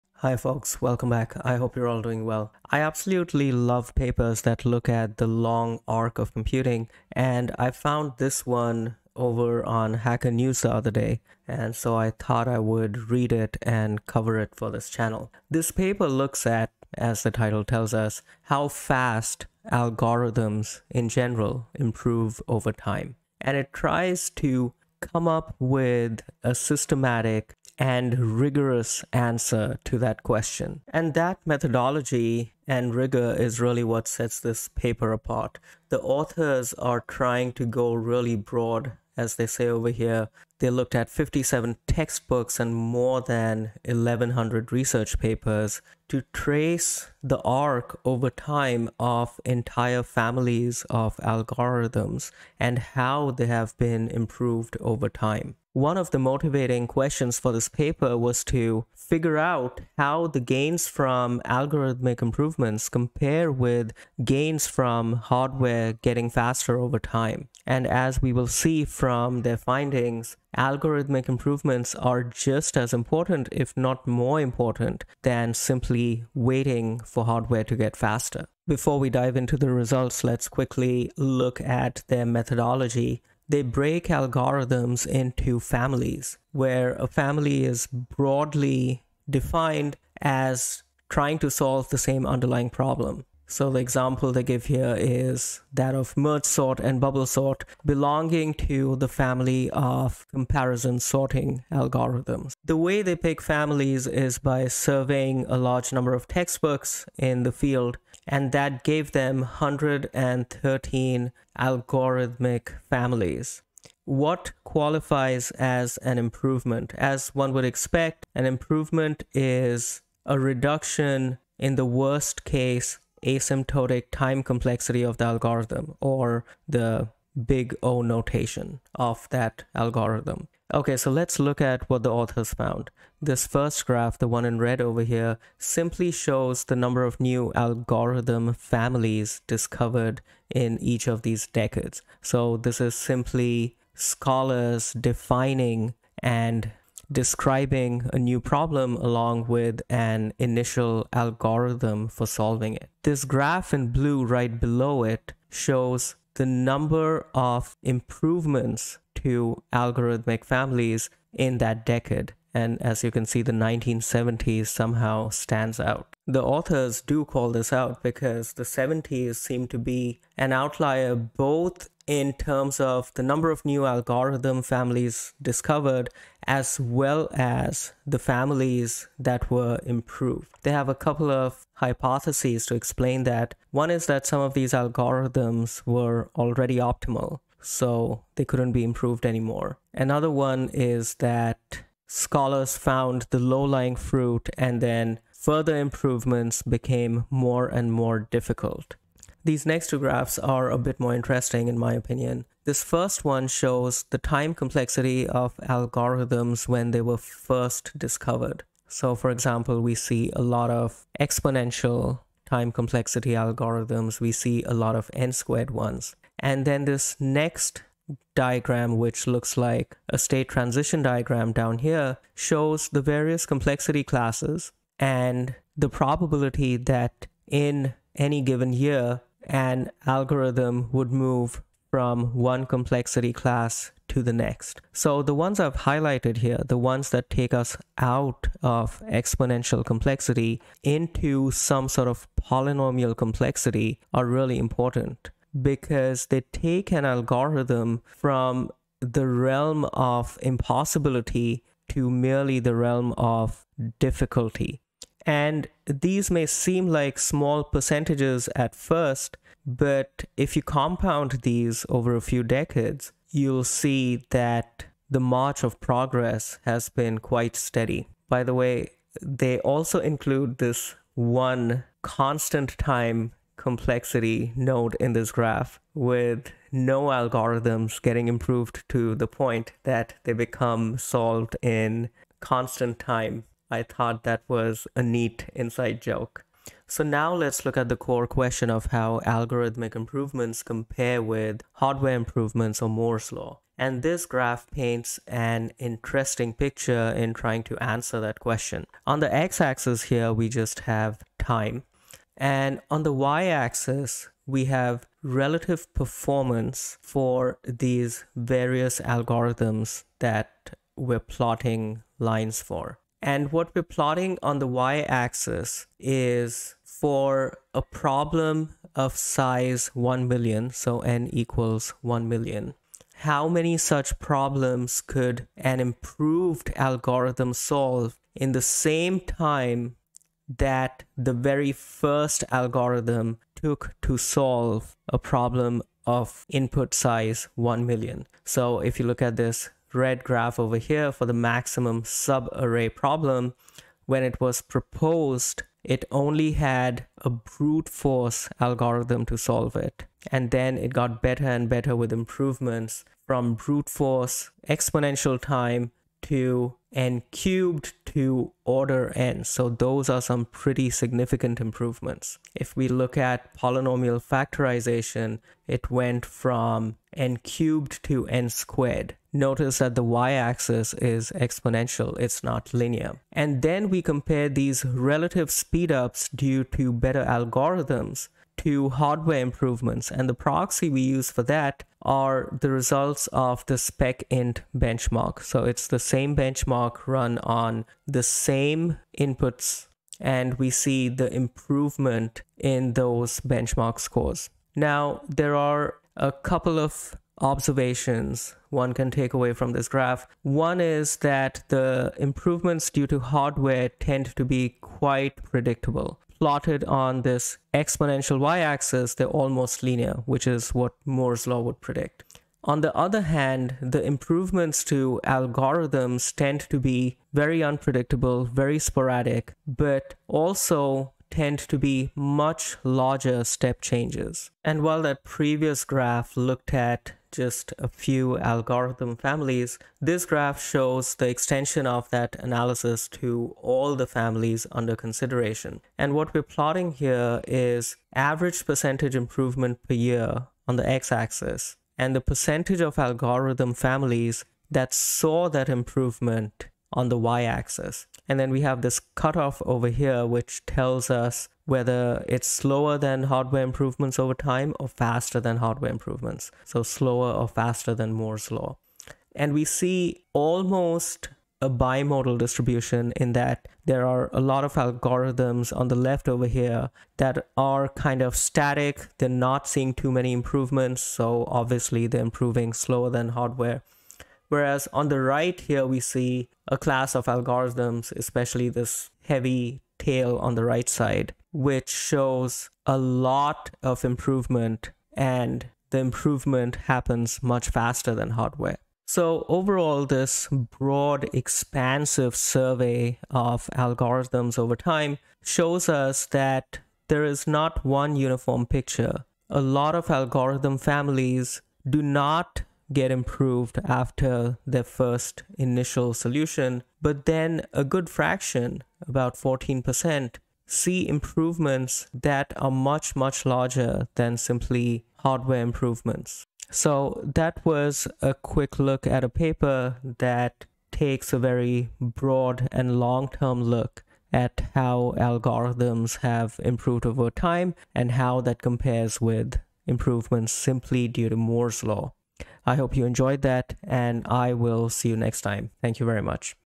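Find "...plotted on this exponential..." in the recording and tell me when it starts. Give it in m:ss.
6:46.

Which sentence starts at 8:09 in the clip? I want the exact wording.
So, overall, this broad, expansive survey of algorithms over time shows us that there is not one uniform picture.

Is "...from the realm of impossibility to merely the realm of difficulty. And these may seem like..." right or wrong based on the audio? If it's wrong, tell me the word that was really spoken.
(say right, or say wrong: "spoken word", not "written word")
right.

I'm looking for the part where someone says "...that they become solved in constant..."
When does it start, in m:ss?
4:39.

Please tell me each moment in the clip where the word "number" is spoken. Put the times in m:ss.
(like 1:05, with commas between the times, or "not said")
1:45, 2:16, 2:36, 2:53.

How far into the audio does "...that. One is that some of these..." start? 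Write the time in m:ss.
3:03.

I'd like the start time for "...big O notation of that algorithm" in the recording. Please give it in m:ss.
2:07.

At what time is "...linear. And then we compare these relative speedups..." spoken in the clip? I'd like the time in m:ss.
6:12.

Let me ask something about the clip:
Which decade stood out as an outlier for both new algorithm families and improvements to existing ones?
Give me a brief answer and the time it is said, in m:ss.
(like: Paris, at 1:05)
1970s, at 2:43.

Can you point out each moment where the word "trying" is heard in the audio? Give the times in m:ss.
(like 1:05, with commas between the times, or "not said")
0:37, 1:31, 4:57.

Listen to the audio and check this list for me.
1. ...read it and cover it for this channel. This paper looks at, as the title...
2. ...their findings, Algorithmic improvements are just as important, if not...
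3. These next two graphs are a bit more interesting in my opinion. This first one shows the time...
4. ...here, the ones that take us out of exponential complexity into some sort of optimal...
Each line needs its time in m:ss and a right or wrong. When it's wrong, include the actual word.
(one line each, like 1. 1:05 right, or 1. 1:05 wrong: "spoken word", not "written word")
1. 0:13 right
2. 1:09 right
3. 3:19 right
4. 3:56 wrong: "polynomial", not "optimal".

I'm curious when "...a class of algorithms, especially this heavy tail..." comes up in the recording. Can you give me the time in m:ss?
7:56.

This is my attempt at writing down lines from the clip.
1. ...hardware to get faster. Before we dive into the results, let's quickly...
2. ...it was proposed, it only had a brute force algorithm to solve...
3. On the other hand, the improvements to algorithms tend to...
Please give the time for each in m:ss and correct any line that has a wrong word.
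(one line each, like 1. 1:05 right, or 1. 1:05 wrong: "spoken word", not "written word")
1. 1:17 right
2. 5:44 right
3. 6:52 right.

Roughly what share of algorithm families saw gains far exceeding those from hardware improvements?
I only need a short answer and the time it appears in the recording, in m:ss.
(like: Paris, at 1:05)
14%, at 8:29.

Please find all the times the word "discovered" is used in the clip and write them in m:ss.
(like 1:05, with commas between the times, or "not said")
2:19, 2:55, 3:27.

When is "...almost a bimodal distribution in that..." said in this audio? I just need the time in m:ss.
7:40.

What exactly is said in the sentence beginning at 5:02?
And on the y axis, we have relative performance for these various algorithms that we're plotting lines for.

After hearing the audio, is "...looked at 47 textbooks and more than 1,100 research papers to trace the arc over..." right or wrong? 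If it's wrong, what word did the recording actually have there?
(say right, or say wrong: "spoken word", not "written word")
wrong: "57", not "47".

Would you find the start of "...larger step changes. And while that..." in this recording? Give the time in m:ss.
7:02.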